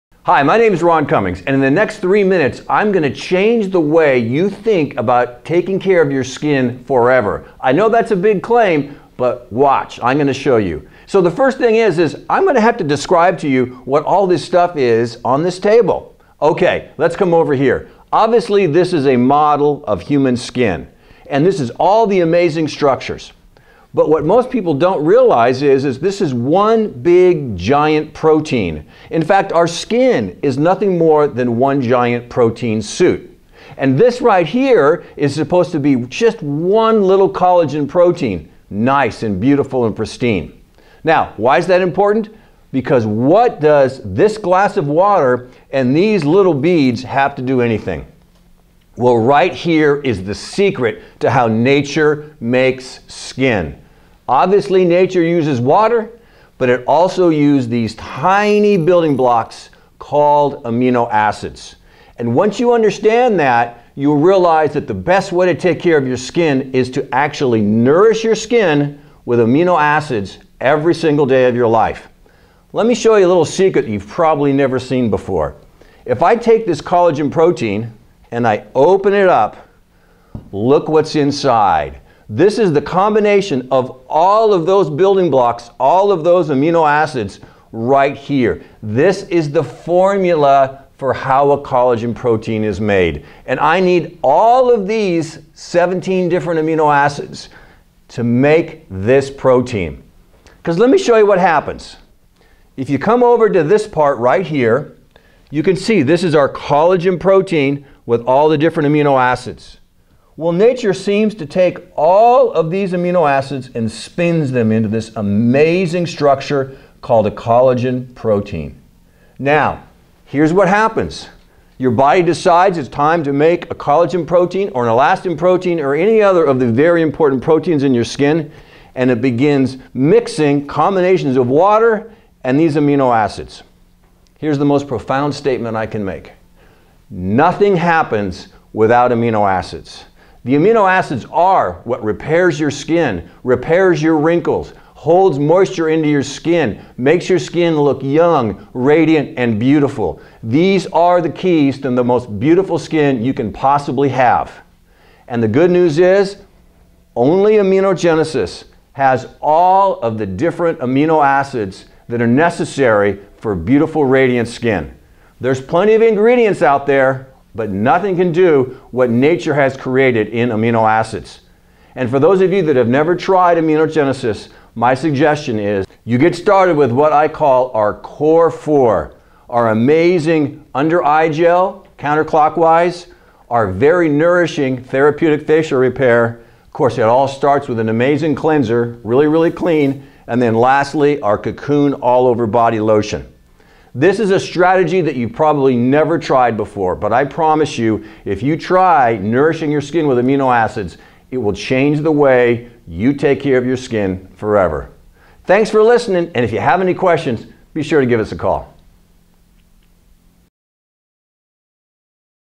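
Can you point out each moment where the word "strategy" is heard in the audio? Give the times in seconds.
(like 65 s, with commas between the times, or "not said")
194 s.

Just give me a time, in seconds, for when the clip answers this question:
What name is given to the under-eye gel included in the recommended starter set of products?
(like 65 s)
181 s.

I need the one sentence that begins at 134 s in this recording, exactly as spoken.
Here's the most profound statement I can make.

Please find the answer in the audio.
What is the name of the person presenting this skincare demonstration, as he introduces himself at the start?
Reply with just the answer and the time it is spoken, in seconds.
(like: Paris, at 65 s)
Ron Cummings, at 0 s.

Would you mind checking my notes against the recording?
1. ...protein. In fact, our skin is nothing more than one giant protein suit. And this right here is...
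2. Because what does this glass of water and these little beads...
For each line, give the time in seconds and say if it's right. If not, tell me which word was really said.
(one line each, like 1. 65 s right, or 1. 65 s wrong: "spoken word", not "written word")
1. 28 s right
2. 42 s right.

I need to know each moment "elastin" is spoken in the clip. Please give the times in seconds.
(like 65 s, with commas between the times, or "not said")
124 s.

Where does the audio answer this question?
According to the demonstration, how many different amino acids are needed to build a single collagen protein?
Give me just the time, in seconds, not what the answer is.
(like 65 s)
95 s.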